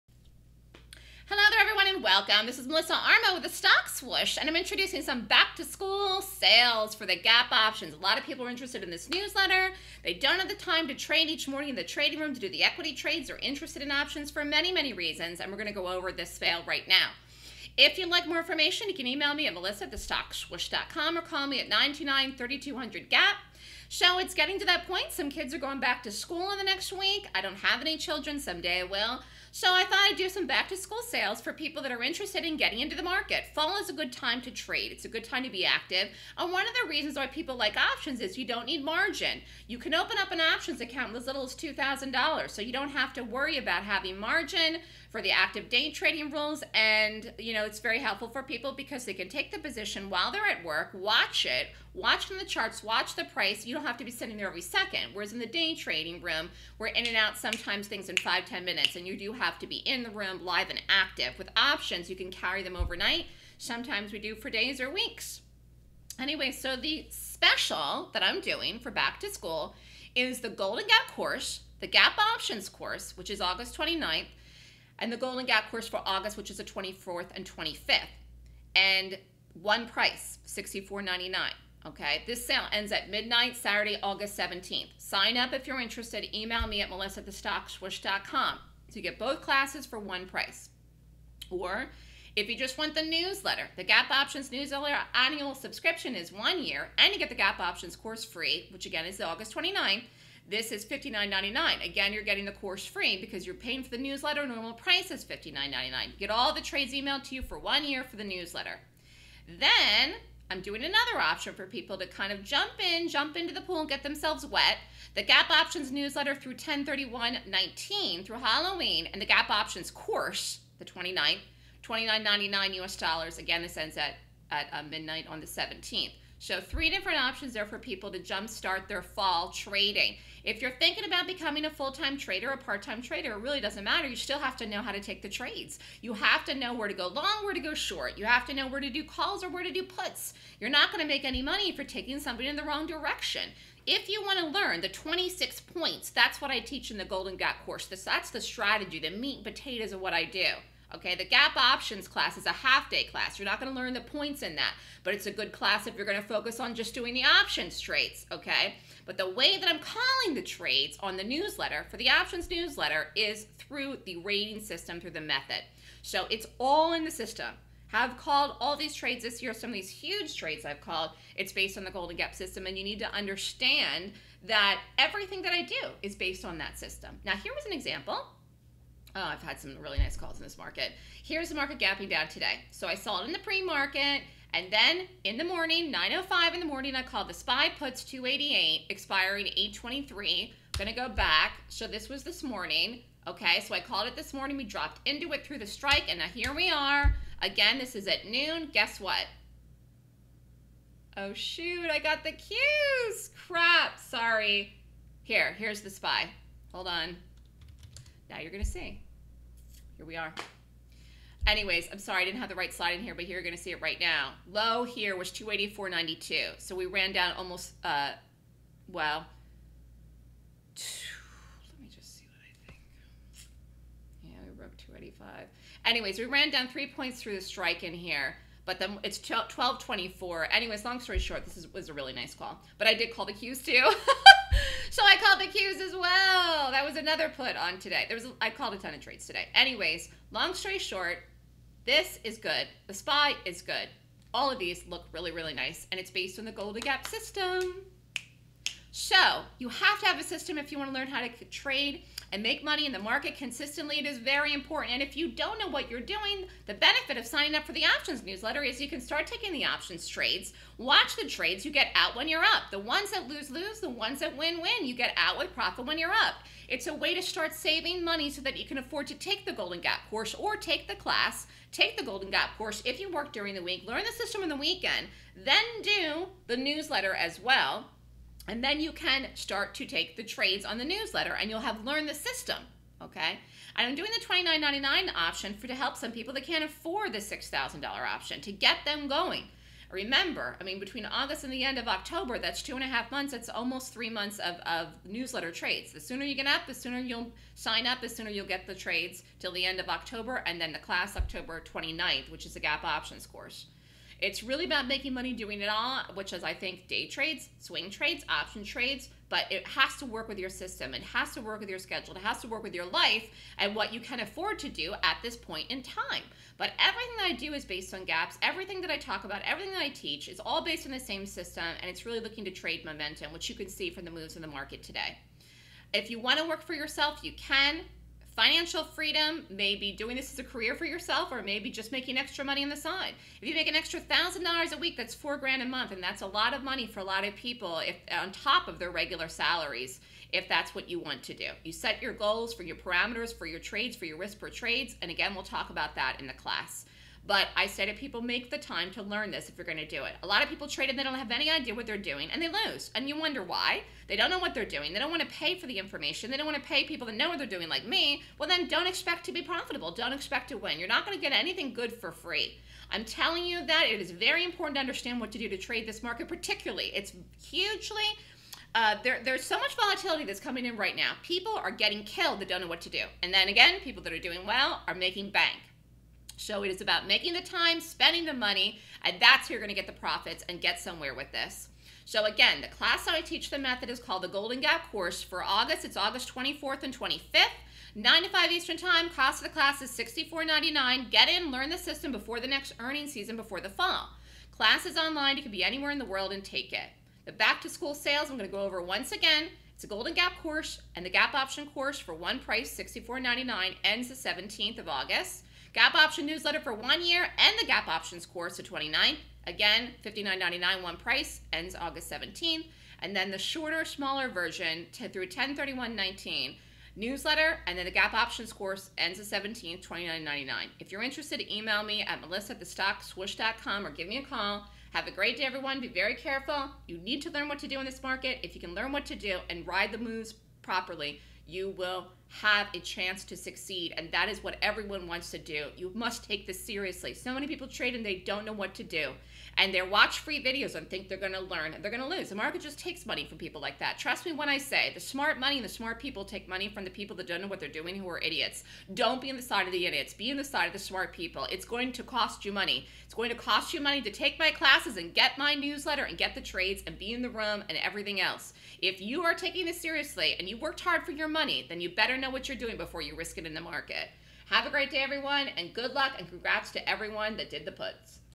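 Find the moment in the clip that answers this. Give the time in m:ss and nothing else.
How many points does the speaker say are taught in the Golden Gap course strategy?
2:24.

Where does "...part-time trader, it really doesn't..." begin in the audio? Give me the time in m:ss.
2:12.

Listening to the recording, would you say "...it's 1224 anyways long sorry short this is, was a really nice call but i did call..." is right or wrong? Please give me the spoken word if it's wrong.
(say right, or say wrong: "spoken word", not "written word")
wrong: "story", not "sorry".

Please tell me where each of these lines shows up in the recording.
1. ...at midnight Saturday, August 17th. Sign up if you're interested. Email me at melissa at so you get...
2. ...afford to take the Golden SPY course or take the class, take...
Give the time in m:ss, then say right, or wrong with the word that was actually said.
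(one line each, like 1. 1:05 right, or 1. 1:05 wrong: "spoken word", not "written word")
1. 1:22 right
2. 4:28 wrong: "Gap", not "SPY".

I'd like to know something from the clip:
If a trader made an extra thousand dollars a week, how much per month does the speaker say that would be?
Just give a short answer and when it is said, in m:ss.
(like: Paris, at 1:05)
four grand, at 5:35.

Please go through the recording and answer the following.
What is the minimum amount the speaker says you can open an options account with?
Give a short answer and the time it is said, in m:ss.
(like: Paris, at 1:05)
$2,000, at 0:41.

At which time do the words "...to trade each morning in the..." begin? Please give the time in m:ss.
0:10.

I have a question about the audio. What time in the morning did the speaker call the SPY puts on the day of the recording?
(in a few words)
9:05.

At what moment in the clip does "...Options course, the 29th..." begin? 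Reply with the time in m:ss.
1:59.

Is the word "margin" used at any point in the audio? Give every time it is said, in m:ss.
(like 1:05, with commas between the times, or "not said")
0:38, 0:44.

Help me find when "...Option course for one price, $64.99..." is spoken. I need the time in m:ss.
6:41.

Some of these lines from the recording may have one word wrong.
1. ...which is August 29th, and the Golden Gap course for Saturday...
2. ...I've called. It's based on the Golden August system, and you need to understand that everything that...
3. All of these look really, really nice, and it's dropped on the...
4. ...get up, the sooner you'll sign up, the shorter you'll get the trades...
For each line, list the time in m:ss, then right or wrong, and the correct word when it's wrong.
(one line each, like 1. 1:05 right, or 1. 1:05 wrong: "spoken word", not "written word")
1. 1:13 wrong: "August", not "Saturday"
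2. 2:50 wrong: "Gap", not "August"
3. 4:04 wrong: "based", not "dropped"
4. 4:56 wrong: "sooner", not "shorter".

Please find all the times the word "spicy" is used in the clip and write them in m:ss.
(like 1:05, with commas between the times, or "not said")
not said.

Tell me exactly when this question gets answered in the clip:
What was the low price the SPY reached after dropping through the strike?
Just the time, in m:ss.
3:35.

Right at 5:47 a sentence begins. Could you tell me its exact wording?
But I say to people, make the time to learn this if you're going to do it.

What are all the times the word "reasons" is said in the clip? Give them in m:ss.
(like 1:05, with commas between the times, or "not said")
0:14, 0:36.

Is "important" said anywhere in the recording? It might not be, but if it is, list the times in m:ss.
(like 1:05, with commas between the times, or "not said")
4:14, 6:04.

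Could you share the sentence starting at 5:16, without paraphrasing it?
But everything that I do is based on gaps.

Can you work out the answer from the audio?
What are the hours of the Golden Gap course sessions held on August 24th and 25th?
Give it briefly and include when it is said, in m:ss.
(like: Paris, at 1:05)
9 to 5 Eastern Time, at 6:27.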